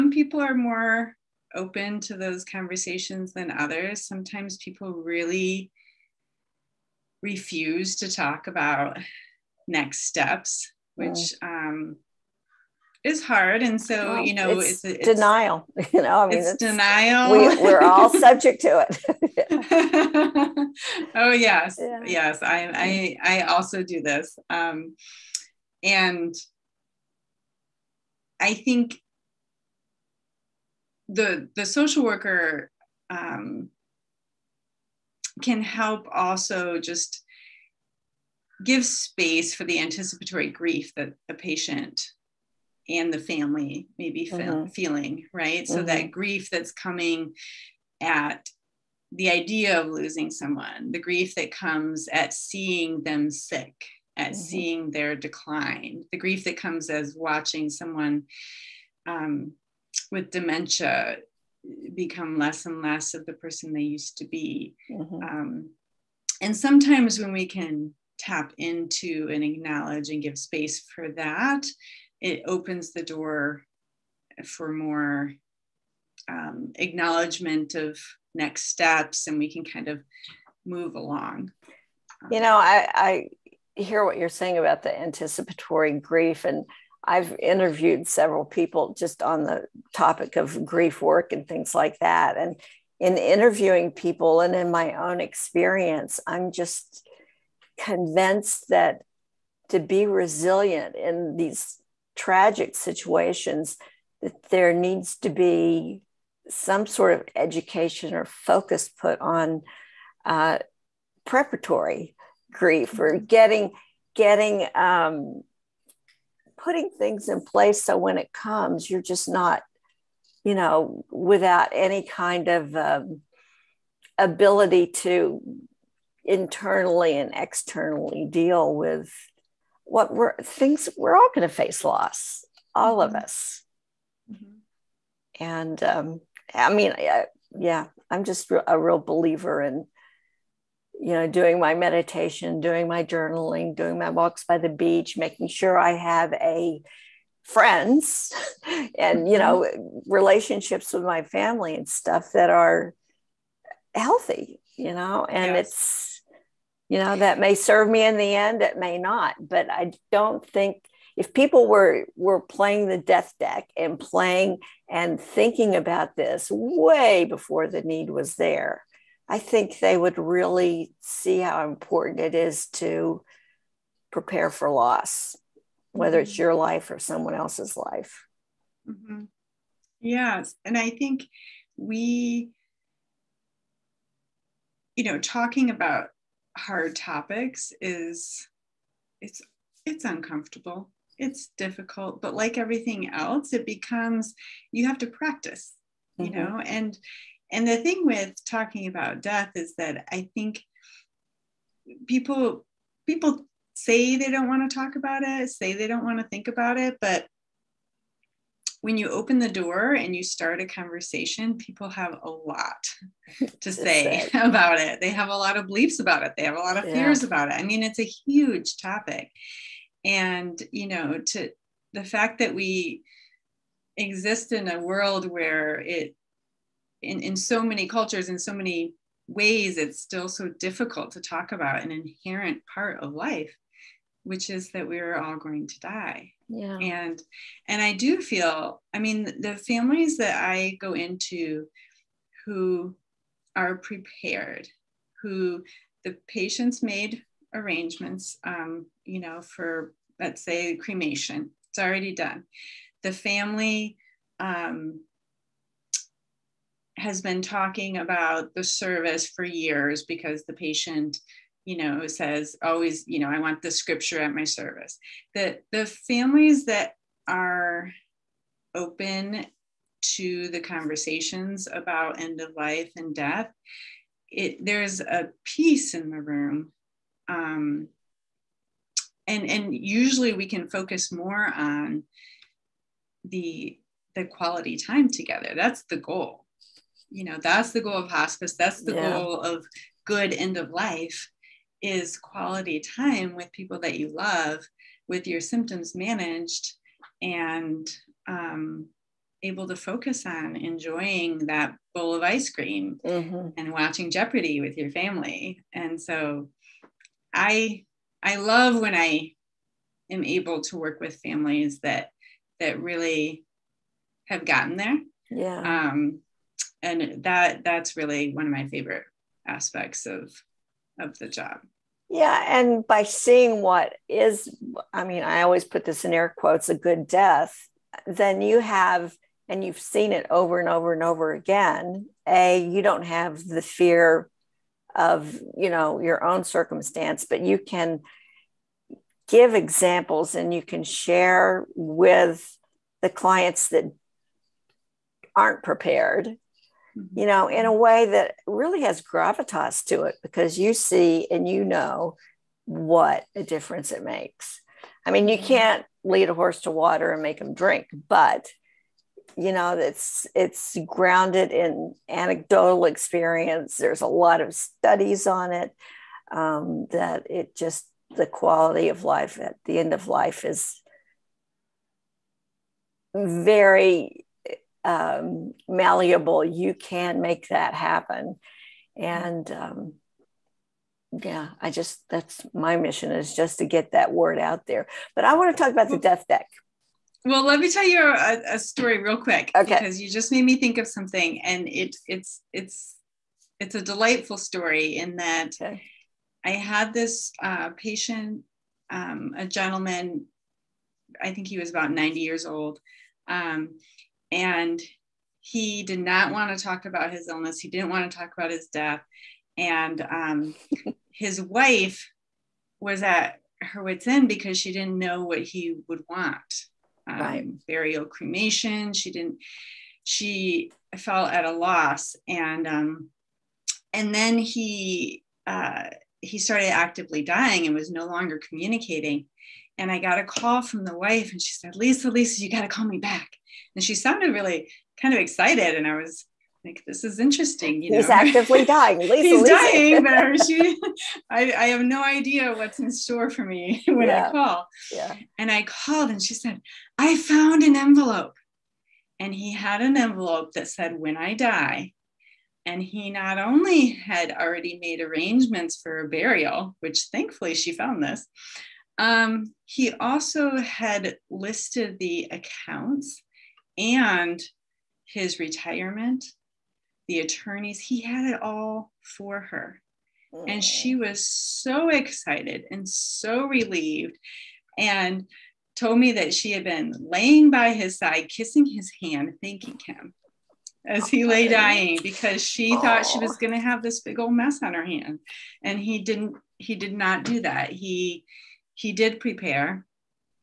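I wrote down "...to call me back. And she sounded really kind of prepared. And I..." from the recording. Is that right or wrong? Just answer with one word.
wrong.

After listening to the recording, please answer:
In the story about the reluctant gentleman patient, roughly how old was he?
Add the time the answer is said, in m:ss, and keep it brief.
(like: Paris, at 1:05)
90, at 6:41.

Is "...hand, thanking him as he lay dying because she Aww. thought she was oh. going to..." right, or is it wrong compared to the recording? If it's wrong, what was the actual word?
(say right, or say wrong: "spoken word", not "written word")
right.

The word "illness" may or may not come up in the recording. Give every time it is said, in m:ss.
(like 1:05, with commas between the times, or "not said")
6:47.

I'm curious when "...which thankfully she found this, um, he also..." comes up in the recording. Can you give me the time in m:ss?
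7:36.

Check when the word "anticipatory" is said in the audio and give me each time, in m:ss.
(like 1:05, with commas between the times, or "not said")
0:39, 1:24.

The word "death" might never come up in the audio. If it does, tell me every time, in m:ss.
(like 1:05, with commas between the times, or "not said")
2:42, 3:19, 4:33, 5:27, 6:25, 6:48.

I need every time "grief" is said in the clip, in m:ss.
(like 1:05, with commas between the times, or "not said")
0:40, 0:46, 0:50, 0:56, 1:25, 1:30, 1:52.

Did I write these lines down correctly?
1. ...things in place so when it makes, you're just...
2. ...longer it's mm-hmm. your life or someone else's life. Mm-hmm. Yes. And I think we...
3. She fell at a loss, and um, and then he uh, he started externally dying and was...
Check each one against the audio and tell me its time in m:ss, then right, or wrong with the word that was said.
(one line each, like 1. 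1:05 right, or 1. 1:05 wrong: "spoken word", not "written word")
1. 1:56 wrong: "comes", not "makes"
2. 2:55 wrong: "whether", not "longer"
3. 7:00 wrong: "actively", not "externally".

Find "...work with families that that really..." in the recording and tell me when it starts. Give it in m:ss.
5:10.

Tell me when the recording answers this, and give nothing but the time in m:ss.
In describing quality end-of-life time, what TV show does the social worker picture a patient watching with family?
5:04.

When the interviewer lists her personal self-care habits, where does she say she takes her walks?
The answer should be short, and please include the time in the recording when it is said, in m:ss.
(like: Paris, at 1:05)
by the beach, at 2:24.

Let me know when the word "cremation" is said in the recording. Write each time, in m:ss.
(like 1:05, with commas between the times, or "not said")
4:10, 6:58.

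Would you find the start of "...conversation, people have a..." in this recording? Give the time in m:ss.
3:30.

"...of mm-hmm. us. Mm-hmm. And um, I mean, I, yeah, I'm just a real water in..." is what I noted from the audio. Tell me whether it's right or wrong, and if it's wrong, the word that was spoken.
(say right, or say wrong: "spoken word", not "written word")
wrong: "believer", not "water".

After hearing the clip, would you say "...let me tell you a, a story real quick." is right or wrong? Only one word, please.
right.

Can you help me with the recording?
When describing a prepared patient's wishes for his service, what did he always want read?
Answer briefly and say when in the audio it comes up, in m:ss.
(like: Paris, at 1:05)
the scripture, at 4:23.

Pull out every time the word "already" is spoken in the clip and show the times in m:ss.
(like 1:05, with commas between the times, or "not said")
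4:11, 7:34.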